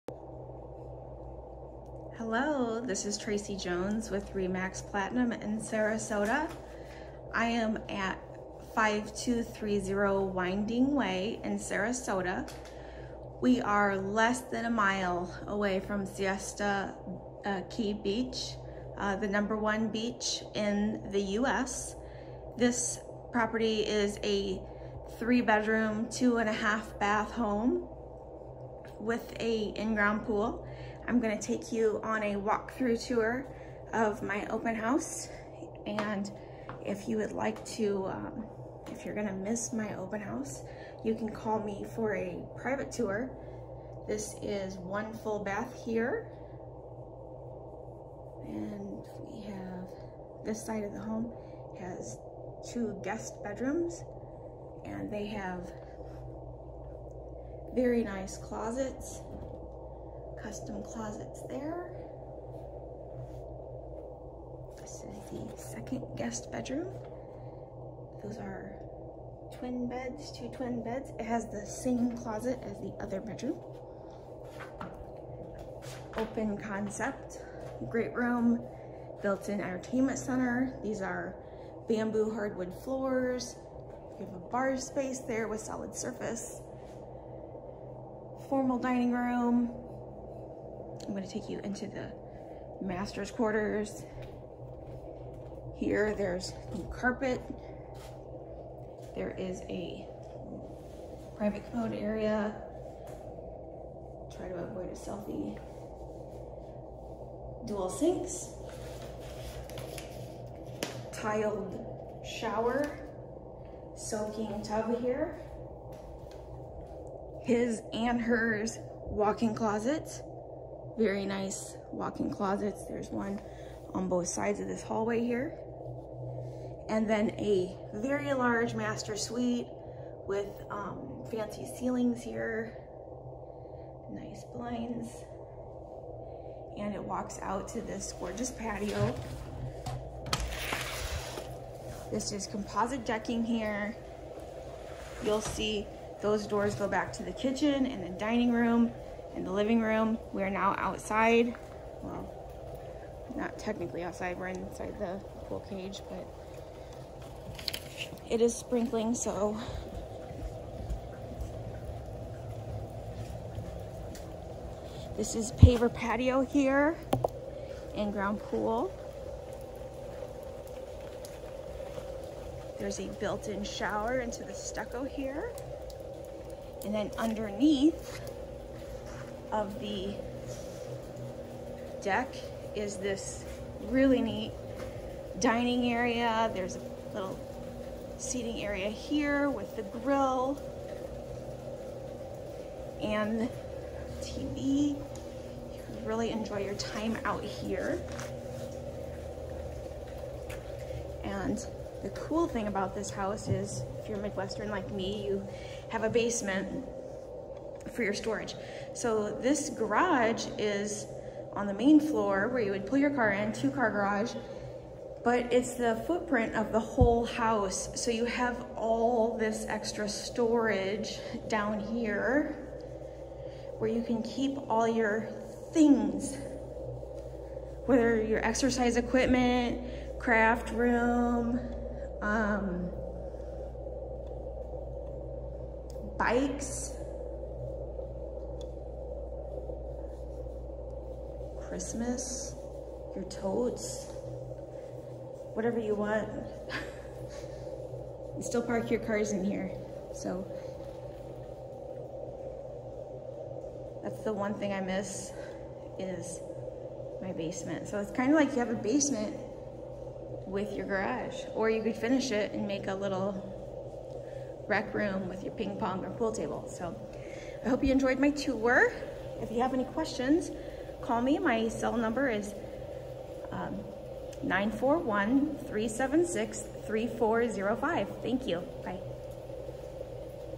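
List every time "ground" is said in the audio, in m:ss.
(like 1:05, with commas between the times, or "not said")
0:29, 2:48.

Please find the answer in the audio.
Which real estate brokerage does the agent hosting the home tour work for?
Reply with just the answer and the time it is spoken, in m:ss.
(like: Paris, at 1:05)
Remax Platinum, at 0:04.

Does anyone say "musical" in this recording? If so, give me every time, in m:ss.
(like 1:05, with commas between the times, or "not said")
not said.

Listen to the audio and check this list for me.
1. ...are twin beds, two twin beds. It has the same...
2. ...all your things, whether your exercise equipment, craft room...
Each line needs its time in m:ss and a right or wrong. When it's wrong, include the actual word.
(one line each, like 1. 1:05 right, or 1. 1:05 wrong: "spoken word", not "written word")
1. 1:08 right
2. 3:44 right.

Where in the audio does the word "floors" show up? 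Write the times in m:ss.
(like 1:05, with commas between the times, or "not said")
1:22, 3:31.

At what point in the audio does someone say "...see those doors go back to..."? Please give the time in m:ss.
2:25.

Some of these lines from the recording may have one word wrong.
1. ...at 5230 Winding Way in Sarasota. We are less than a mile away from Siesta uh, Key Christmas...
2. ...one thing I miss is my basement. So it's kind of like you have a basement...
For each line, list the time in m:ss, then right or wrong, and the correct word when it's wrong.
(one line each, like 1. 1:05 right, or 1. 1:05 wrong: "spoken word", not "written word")
1. 0:07 wrong: "Beach", not "Christmas"
2. 4:14 right.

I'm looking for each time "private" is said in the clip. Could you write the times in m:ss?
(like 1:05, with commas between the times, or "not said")
0:42, 1:41.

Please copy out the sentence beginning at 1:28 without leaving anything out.
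Formal dining room, I'm gonna take you into the master's quarters.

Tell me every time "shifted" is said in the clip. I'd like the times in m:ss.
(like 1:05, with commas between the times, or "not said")
not said.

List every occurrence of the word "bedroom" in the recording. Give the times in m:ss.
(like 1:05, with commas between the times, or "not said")
0:25, 0:53, 1:06, 1:13.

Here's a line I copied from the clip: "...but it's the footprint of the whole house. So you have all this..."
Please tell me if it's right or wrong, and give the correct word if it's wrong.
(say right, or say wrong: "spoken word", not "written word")
right.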